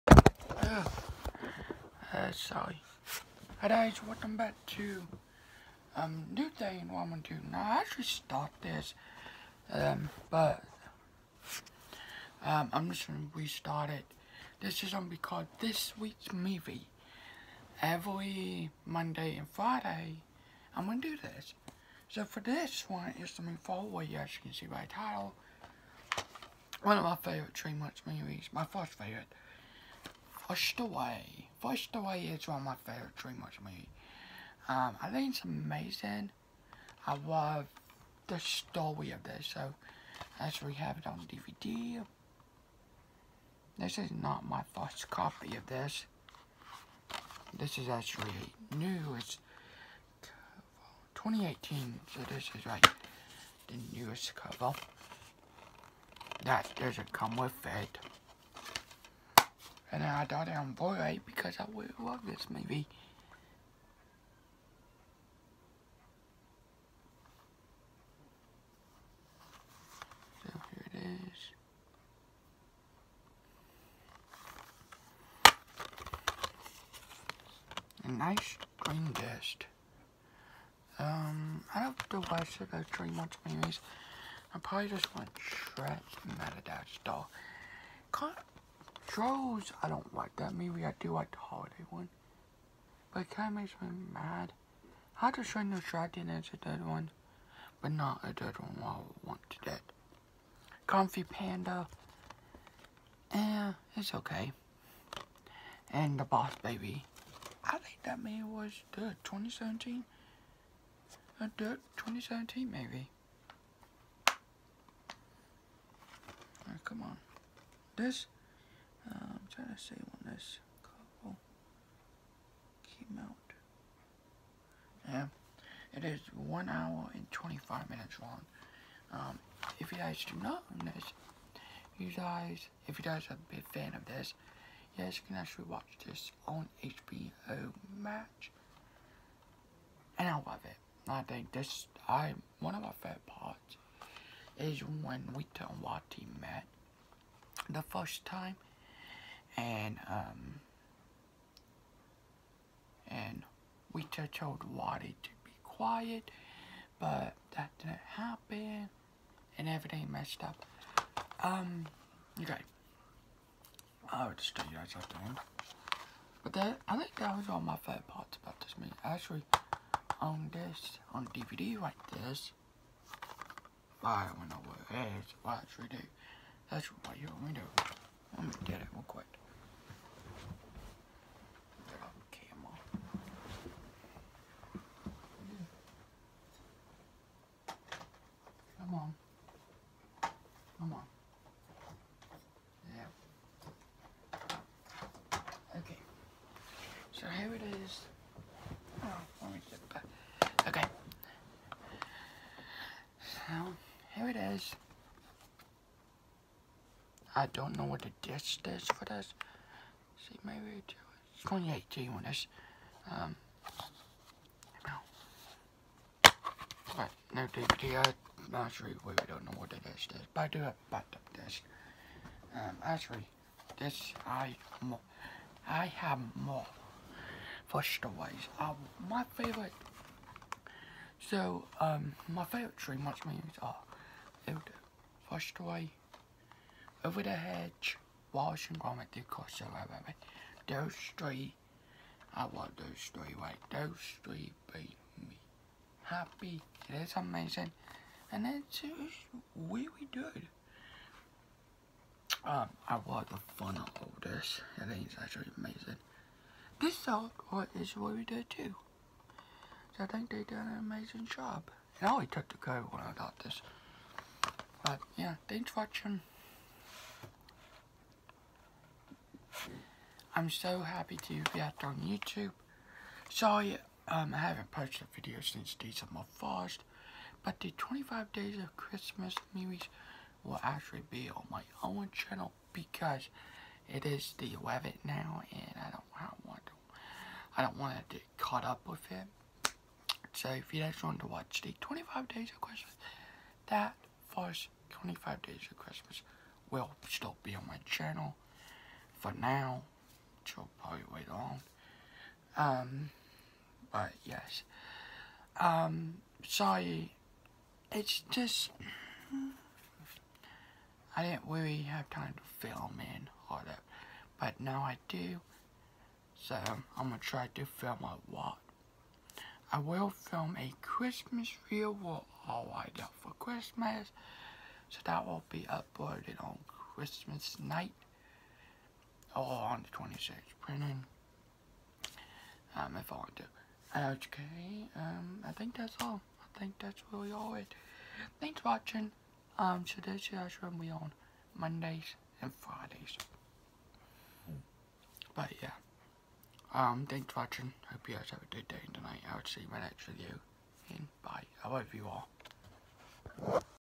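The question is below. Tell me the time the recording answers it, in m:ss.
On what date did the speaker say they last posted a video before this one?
4:35.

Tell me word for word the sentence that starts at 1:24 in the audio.
I probably just want Shrek and Doll.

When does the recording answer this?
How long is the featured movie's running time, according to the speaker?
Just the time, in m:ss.
2:06.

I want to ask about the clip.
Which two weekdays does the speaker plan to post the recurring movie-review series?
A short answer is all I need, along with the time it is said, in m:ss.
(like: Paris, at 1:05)
Monday and Friday, at 0:18.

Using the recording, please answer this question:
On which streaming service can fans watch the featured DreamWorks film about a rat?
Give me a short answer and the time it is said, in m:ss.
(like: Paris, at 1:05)
HBO Max, at 2:16.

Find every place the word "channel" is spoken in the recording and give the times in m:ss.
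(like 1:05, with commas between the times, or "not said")
4:42, 4:57.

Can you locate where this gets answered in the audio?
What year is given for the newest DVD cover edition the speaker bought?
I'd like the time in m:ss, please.
0:51.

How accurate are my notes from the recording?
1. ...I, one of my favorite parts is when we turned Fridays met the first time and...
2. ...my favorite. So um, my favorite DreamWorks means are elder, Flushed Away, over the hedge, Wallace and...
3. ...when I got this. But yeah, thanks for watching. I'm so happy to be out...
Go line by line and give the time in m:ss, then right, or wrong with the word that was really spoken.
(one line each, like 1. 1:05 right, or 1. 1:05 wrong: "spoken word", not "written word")
1. 2:22 wrong: "Watty", not "Fridays"
2. 3:49 right
3. 4:22 right.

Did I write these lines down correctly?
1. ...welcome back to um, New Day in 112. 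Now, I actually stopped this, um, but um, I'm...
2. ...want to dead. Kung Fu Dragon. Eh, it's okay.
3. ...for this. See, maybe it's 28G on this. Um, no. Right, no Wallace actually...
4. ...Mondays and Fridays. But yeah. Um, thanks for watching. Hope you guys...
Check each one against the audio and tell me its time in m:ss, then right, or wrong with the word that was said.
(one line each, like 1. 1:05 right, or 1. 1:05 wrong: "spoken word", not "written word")
1. 0:04 right
2. 1:39 wrong: "Panda", not "Dragon"
3. 3:28 wrong: "DVD", not "Wallace"
4. 5:41 right.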